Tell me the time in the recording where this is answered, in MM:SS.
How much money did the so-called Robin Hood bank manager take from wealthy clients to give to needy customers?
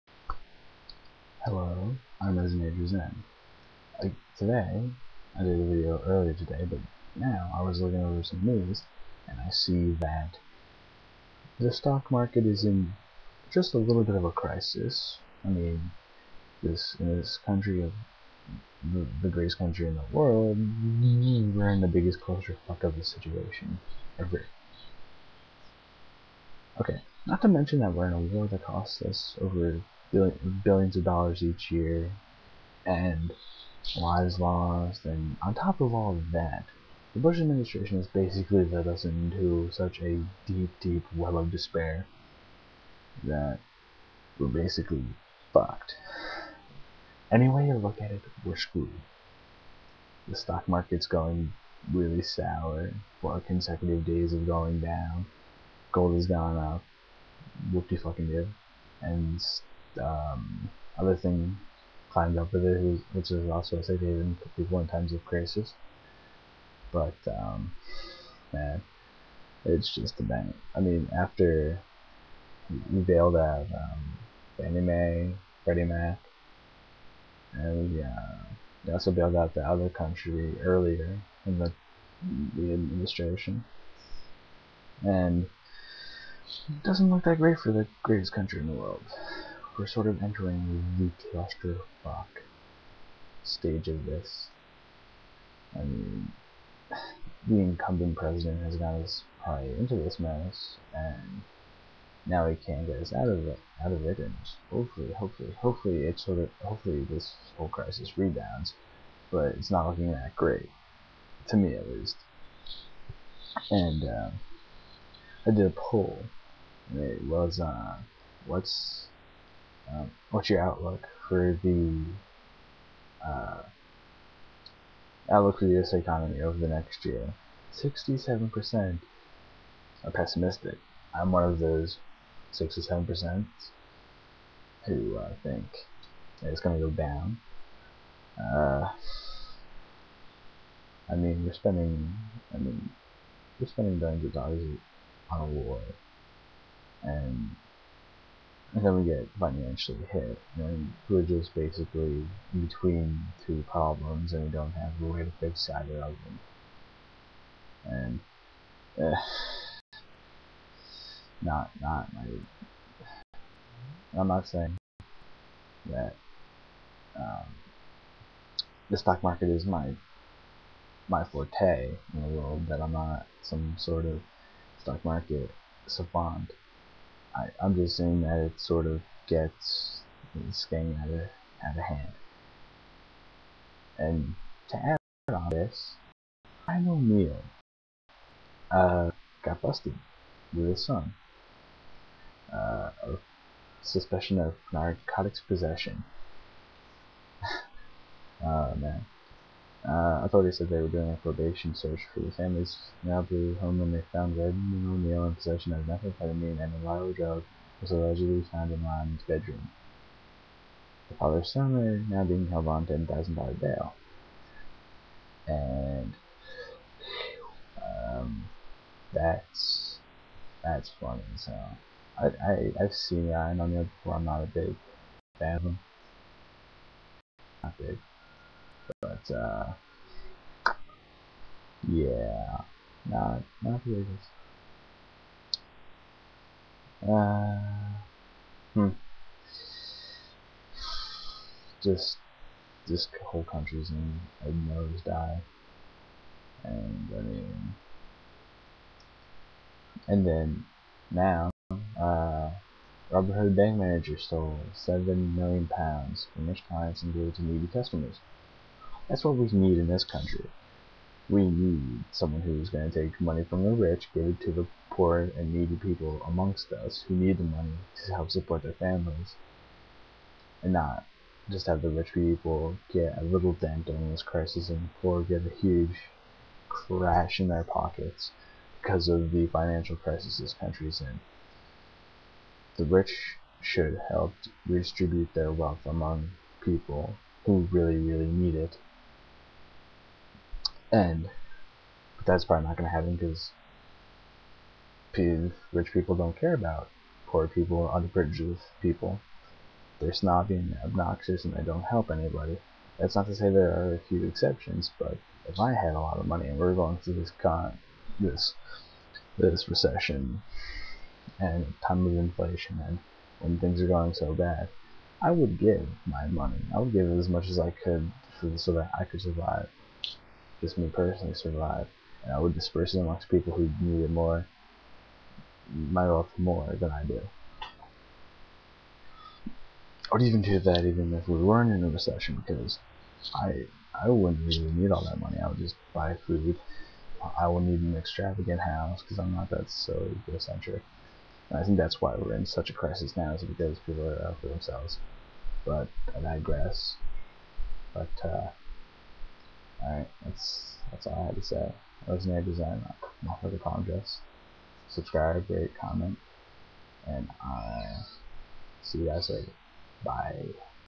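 04:14.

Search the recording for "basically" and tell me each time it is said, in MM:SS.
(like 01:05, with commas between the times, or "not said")
00:38, 00:44, 02:31.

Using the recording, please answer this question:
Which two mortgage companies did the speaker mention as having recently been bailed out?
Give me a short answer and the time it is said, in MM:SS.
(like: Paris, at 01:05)
Fannie Mae, Freddie Mac, at 01:14.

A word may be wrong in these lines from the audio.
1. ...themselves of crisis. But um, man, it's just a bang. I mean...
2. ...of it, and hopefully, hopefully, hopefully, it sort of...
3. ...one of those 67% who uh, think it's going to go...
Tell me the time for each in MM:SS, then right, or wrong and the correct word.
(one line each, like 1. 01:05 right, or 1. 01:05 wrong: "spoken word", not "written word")
1. 01:04 wrong: "times", not "themselves"
2. 01:43 right
3. 02:11 right.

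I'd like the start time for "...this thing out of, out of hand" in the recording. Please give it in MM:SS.
03:00.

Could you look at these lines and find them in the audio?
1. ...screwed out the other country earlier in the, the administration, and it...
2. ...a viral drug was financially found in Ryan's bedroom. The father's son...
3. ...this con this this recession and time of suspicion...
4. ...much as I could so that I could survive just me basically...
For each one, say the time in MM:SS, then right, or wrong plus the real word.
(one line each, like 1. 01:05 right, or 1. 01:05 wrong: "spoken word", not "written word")
1. 01:19 wrong: "bailed", not "screwed"
2. 03:26 wrong: "allegedly", not "financially"
3. 05:07 wrong: "inflation", not "suspicion"
4. 05:17 wrong: "personally", not "basically".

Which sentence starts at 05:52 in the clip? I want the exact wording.
was Rosemary Design, my the apologize.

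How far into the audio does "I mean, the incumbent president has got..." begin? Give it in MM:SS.
01:35.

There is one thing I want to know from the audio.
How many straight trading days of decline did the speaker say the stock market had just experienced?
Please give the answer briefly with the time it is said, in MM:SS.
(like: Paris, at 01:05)
4, at 00:53.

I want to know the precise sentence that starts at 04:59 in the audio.
They're snobby and obnoxious and they don't help anybody.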